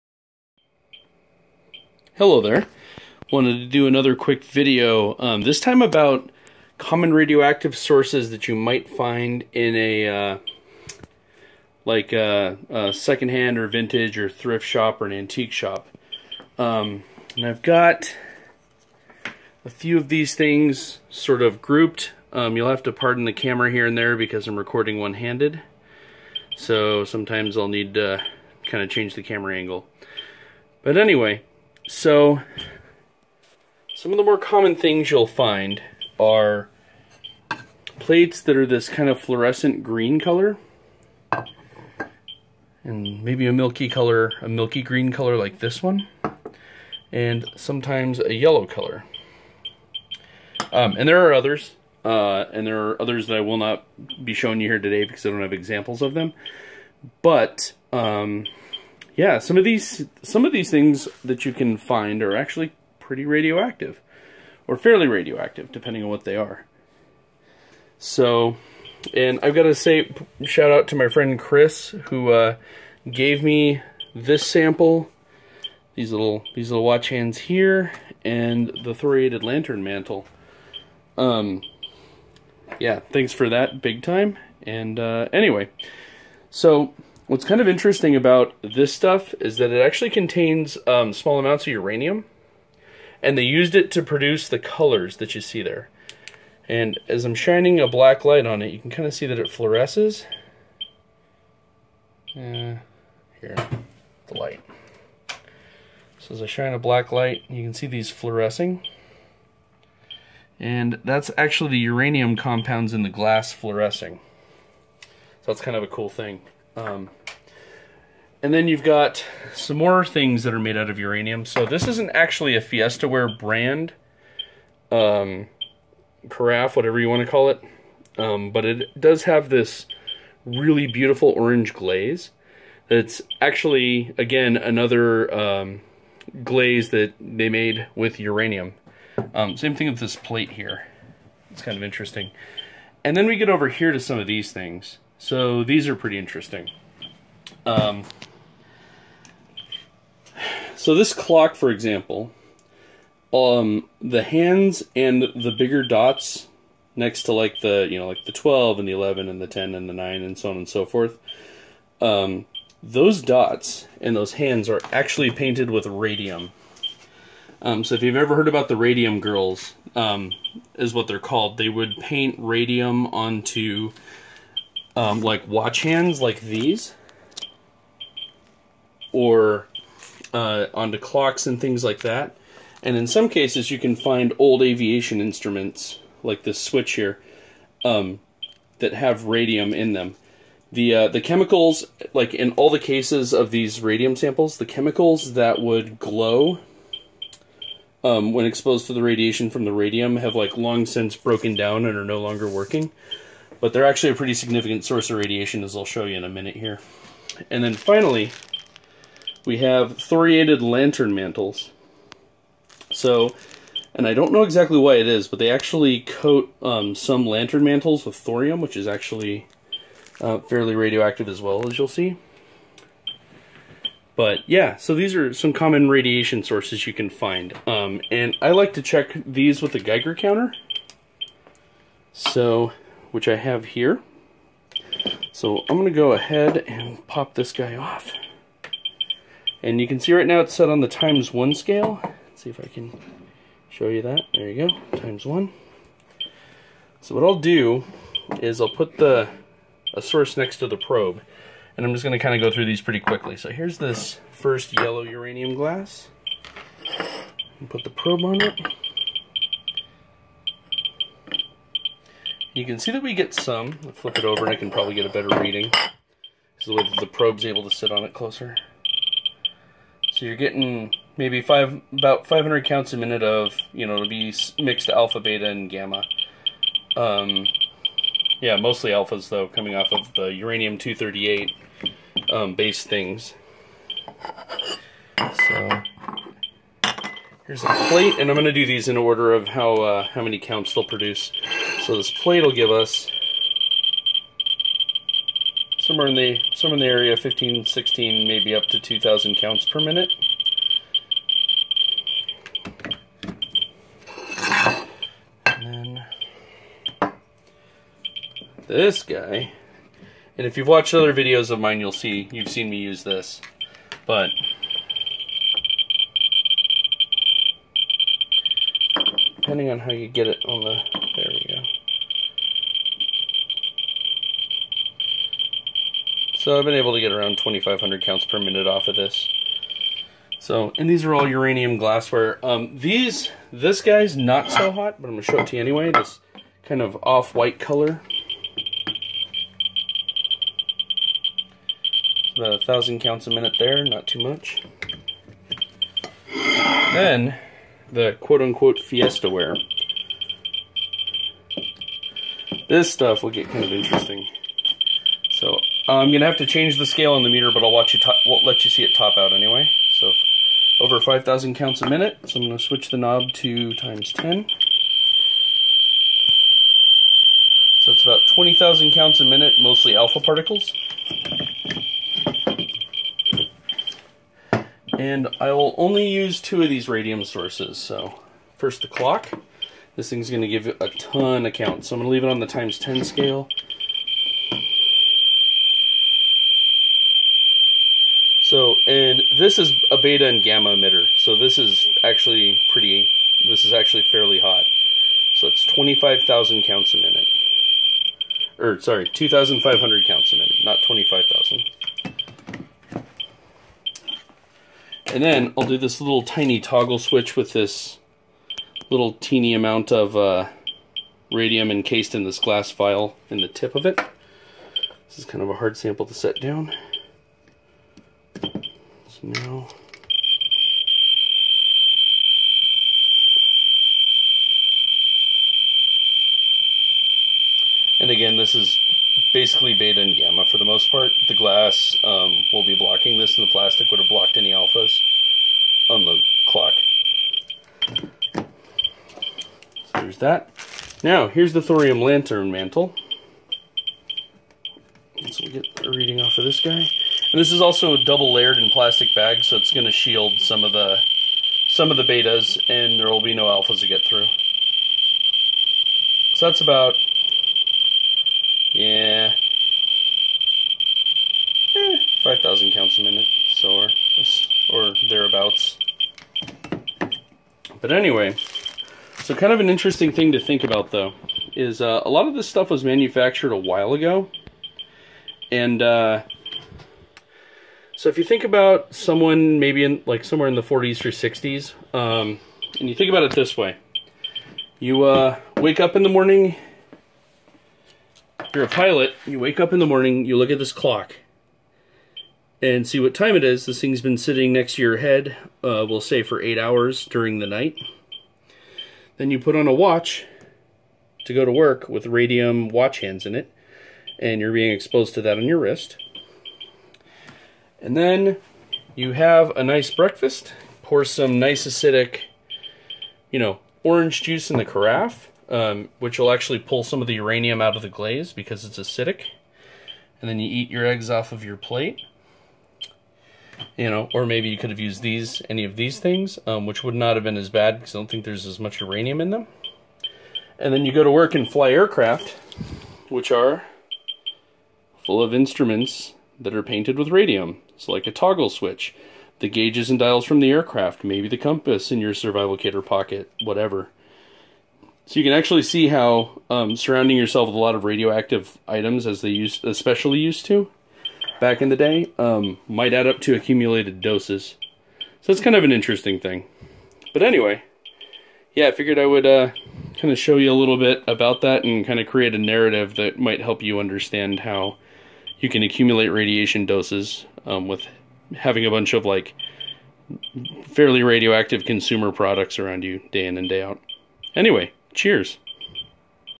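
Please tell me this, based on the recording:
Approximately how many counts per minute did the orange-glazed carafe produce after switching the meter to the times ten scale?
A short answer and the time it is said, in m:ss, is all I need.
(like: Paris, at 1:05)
20,000, at 6:08.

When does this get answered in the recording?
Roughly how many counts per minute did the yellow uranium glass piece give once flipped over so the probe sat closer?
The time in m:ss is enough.
4:32.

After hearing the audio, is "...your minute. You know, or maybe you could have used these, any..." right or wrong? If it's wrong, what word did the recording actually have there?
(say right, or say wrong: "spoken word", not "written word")
wrong: "plate", not "minute".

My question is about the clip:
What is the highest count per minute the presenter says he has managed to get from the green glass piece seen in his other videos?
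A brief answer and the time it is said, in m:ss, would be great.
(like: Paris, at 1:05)
2,500, at 5:27.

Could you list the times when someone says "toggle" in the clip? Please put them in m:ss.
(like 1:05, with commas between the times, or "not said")
6:46, 8:58.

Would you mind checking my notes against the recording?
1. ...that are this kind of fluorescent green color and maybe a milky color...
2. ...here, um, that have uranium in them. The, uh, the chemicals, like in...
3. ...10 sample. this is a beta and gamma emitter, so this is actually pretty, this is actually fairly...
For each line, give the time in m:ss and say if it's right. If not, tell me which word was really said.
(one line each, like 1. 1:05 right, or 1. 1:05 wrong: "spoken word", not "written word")
1. 0:38 right
2. 3:06 wrong: "radium", not "uranium"
3. 6:22 wrong: "scale", not "sample".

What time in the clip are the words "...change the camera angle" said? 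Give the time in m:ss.
0:28.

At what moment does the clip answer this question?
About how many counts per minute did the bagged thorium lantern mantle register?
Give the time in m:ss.
7:42.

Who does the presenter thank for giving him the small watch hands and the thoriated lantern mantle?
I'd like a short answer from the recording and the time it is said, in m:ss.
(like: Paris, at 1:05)
Chris, at 1:11.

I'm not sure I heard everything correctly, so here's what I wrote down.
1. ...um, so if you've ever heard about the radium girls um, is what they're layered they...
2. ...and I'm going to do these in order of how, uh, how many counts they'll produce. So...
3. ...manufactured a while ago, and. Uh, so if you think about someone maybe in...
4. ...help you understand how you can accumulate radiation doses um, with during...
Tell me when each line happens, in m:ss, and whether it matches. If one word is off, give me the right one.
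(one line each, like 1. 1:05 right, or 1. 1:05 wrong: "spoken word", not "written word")
1. 2:47 wrong: "called", not "layered"
2. 4:48 right
3. 7:52 right
4. 9:23 wrong: "having", not "during".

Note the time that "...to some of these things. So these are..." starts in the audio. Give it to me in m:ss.
2:23.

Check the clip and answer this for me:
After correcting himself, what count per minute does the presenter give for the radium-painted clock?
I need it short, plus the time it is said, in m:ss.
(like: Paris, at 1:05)
2,500, at 6:39.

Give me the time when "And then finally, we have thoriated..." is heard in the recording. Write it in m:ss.
3:27.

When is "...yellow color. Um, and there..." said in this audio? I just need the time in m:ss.
0:48.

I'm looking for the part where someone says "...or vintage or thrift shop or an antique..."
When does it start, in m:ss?
0:13.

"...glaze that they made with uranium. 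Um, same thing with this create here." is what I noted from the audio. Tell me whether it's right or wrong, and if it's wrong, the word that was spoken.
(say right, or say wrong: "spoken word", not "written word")
wrong: "plate", not "create".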